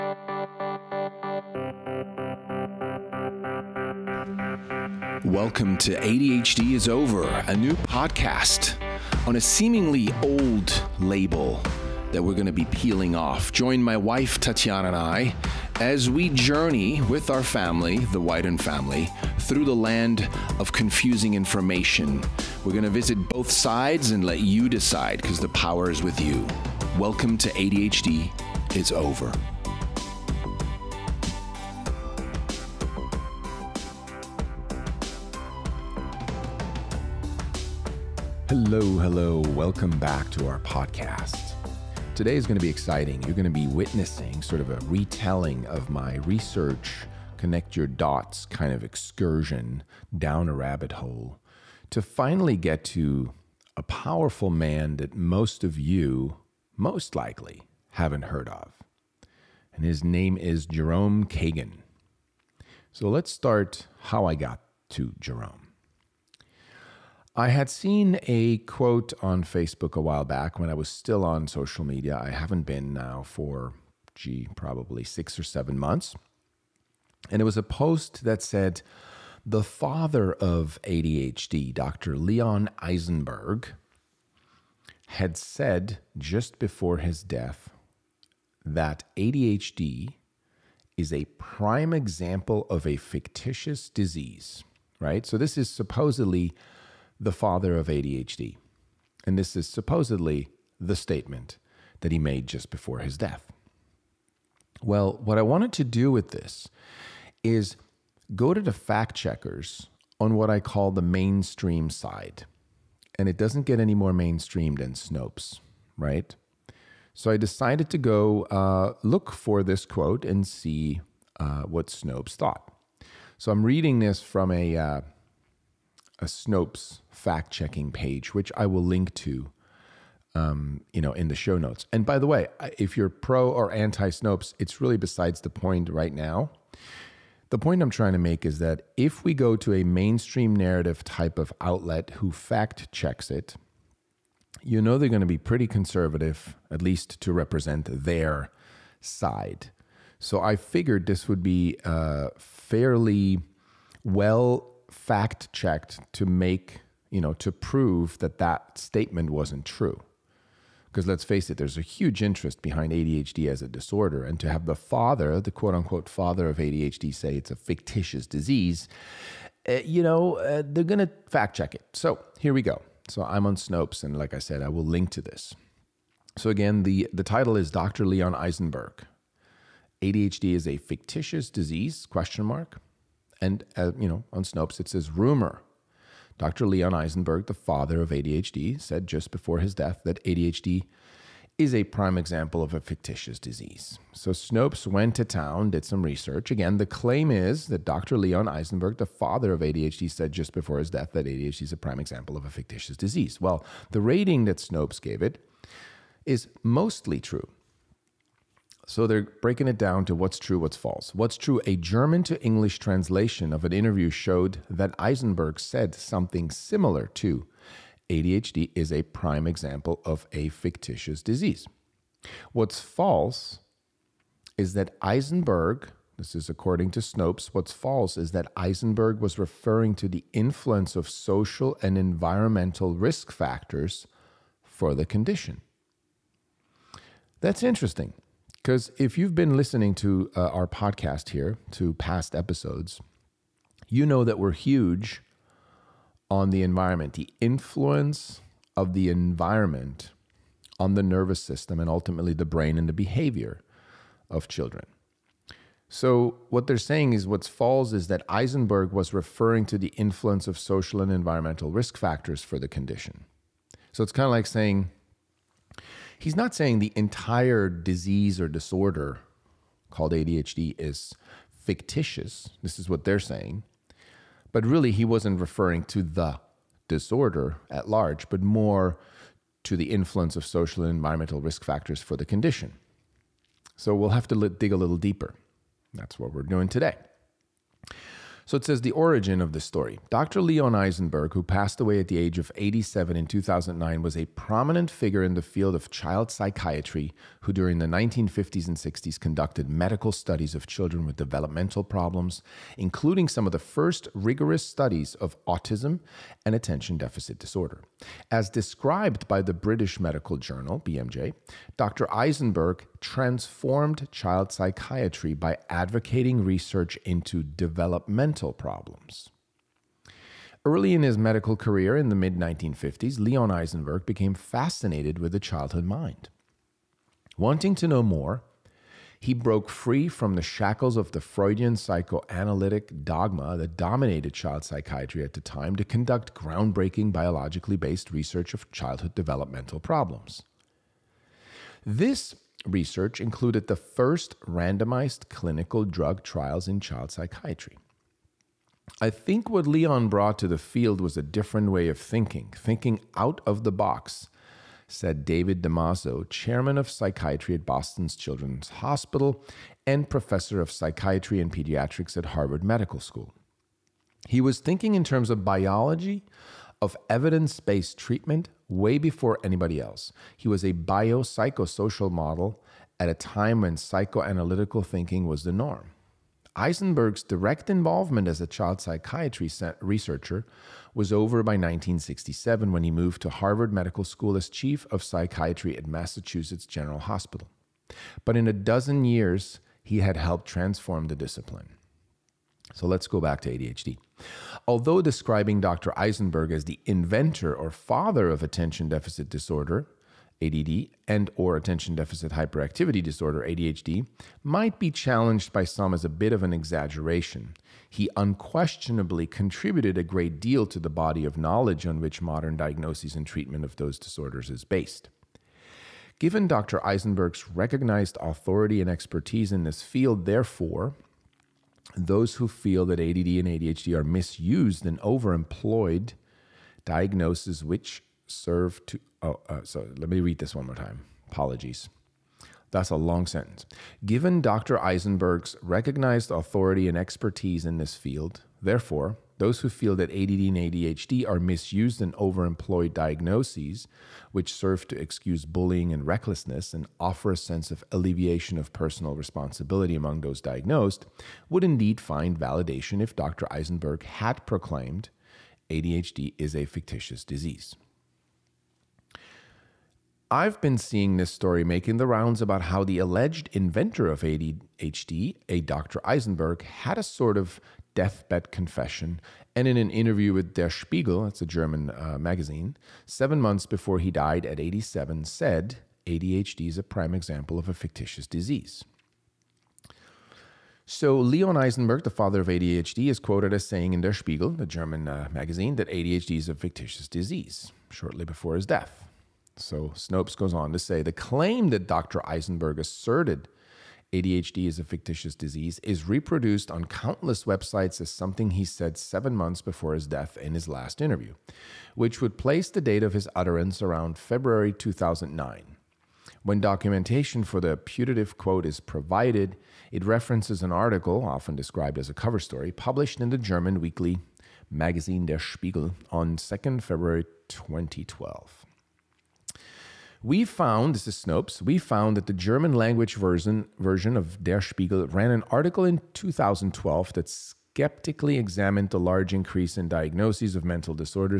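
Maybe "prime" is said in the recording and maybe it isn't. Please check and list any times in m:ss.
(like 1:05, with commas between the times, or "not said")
1:31, 3:11, 3:21, 3:39, 7:56.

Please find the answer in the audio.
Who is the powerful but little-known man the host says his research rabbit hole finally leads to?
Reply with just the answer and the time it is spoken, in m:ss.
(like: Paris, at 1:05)
Jerome Kagan, at 1:00.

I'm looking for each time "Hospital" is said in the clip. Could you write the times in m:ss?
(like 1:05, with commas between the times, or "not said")
5:58, 6:26.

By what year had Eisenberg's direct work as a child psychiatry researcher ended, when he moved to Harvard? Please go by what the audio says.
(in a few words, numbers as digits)
1967.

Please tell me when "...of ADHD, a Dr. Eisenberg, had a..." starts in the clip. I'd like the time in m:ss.
7:44.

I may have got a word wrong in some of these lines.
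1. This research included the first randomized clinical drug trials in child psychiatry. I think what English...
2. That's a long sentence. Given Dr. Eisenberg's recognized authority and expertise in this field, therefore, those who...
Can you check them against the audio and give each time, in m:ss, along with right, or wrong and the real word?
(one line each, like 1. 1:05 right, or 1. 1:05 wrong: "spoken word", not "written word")
1. 5:41 wrong: "Leon", not "English"
2. 7:12 right.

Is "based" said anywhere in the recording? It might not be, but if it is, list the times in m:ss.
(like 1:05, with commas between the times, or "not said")
5:37, 6:07, 6:54.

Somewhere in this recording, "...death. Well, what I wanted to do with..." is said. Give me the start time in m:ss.
1:43.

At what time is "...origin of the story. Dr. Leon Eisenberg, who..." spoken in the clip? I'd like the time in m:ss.
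4:48.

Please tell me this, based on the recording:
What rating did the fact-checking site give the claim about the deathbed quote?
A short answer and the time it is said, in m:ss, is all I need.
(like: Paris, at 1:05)
Mostly true, at 3:26.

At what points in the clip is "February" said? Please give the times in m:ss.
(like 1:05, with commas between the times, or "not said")
8:24, 8:36.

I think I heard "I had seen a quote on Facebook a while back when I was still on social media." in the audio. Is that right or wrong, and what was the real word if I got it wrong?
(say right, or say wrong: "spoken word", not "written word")
right.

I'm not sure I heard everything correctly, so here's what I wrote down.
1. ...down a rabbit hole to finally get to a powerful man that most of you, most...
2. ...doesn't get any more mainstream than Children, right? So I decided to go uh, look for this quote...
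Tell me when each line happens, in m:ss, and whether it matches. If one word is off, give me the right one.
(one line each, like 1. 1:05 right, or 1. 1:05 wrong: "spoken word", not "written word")
1. 0:50 right
2. 1:53 wrong: "Snopes", not "Children".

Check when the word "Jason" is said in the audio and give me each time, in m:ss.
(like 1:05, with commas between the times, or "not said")
not said.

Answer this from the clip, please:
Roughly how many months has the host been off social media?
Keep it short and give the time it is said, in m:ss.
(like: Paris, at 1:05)
6 or 7, at 1:15.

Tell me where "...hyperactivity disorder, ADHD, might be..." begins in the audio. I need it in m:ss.
6:42.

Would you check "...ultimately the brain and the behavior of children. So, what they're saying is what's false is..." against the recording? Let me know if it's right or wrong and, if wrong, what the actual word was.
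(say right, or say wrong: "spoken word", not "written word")
right.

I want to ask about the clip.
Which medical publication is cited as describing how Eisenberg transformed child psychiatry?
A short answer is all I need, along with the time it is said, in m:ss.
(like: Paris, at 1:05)
British Medical Journal, at 5:09.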